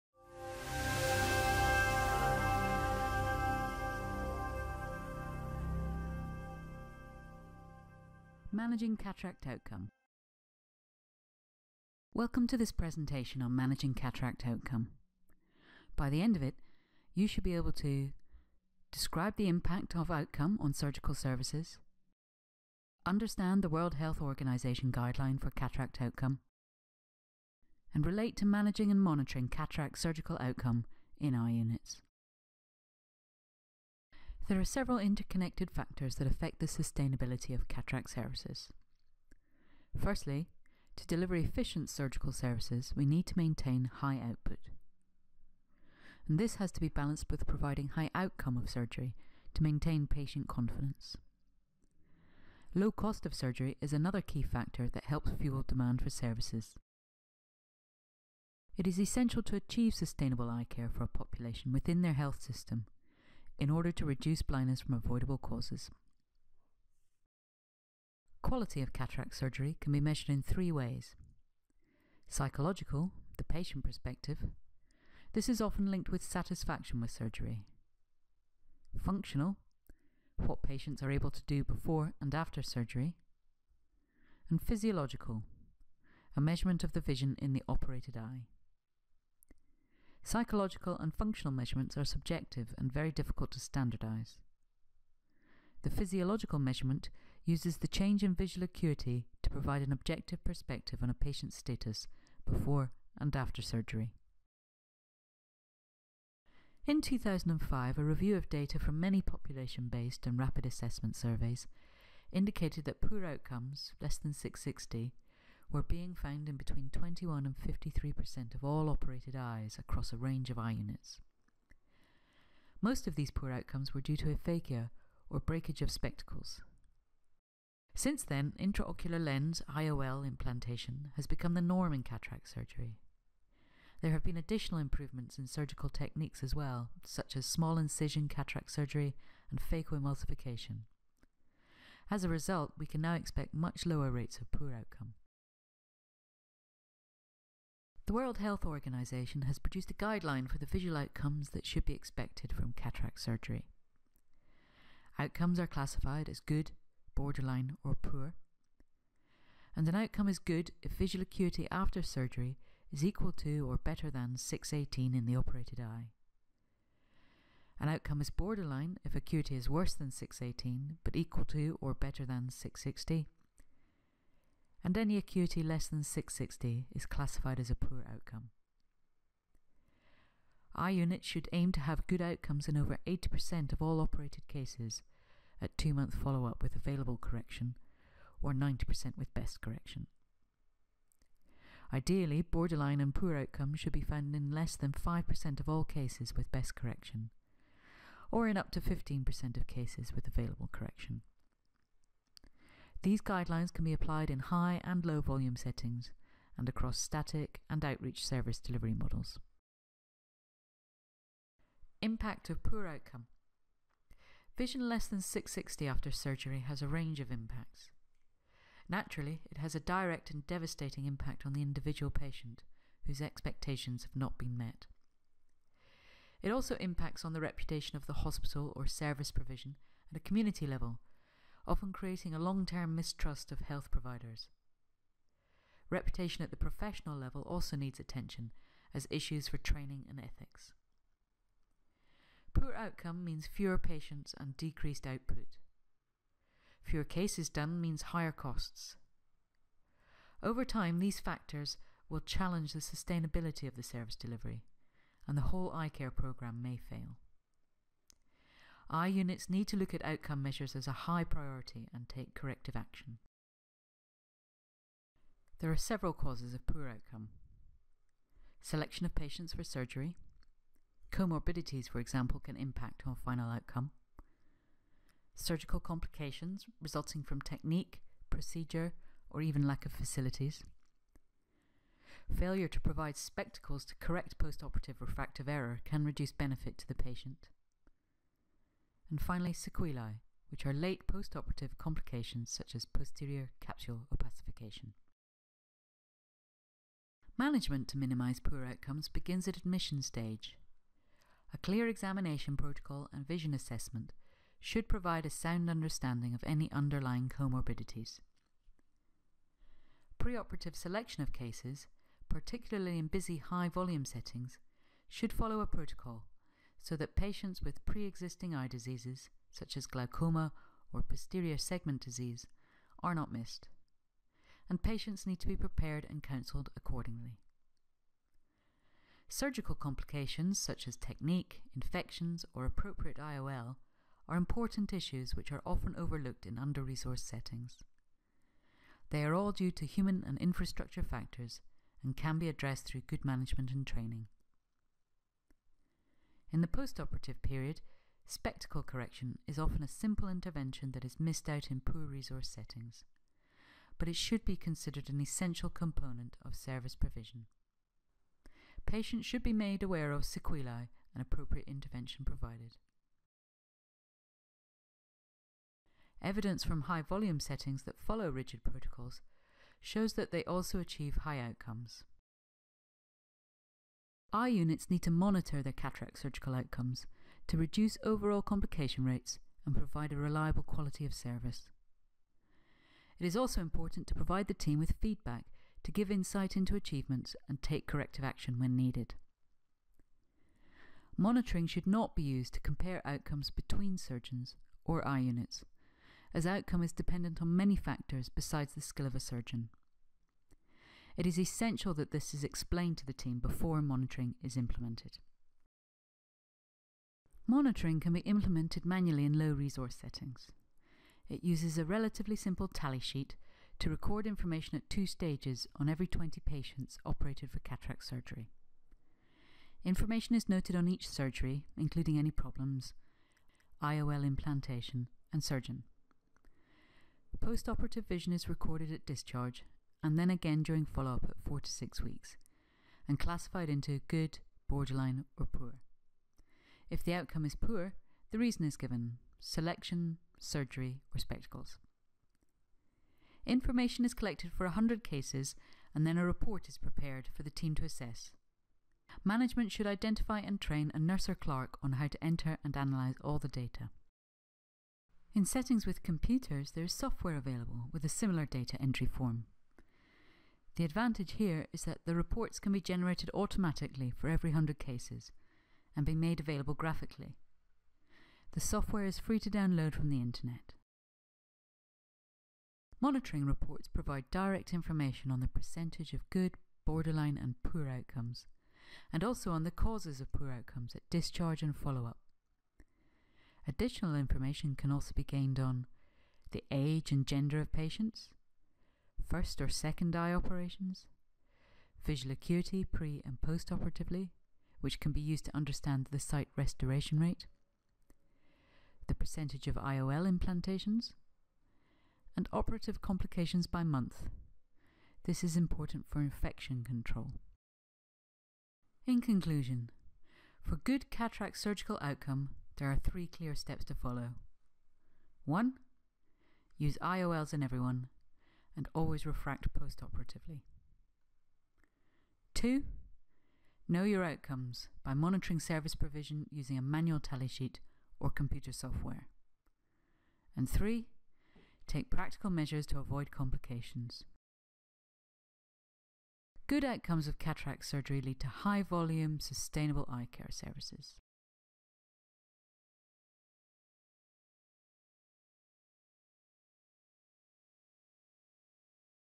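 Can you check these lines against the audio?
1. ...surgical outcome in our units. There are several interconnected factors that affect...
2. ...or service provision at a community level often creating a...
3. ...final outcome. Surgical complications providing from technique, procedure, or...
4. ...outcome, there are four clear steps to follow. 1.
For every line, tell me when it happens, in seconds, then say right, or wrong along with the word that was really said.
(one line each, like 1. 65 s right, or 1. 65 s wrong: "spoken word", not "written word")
1. 29 s right
2. 228 s right
3. 273 s wrong: "resulting", not "providing"
4. 512 s wrong: "three", not "four".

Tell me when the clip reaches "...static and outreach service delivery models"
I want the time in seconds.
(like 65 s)
206 s.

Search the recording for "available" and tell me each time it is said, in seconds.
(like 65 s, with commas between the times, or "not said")
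186 s, 200 s, 457 s, 466 s.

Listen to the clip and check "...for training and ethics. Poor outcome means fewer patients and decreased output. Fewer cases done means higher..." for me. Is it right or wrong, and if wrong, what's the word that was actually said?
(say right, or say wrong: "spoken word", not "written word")
right.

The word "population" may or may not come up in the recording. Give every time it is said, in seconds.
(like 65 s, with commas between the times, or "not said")
61 s, 109 s.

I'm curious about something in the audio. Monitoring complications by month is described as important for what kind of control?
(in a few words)
infection control.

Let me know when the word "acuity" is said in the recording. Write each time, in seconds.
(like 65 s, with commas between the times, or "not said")
98 s, 161 s, 169 s, 175 s, 492 s.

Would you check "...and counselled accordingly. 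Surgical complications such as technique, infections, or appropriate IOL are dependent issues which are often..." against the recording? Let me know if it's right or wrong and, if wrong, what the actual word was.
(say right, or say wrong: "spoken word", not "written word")
wrong: "important", not "dependent".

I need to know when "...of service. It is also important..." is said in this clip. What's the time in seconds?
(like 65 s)
381 s.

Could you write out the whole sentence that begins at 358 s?
Patients should be made aware of sequelae and appropriate intervention provided.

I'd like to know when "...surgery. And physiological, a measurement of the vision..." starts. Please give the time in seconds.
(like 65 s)
82 s.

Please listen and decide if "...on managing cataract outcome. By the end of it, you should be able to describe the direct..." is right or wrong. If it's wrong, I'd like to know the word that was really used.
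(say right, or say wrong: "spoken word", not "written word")
wrong: "impact", not "direct".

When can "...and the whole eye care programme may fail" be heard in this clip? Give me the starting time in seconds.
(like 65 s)
255 s.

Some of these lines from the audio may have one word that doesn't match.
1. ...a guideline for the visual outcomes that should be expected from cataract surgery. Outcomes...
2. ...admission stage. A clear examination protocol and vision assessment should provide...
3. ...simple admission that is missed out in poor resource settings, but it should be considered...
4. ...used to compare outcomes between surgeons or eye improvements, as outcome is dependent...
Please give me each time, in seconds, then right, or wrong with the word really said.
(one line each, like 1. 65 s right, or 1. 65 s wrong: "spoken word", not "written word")
1. 149 s right
2. 299 s right
3. 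349 s wrong: "intervention", not "admission"
4. 392 s wrong: "units", not "improvements".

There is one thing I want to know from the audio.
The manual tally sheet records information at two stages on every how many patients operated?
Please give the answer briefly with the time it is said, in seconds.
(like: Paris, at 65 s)
20, at 416 s.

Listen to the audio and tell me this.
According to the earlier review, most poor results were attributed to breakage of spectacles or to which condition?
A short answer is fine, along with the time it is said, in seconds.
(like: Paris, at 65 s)
aphakia, at 124 s.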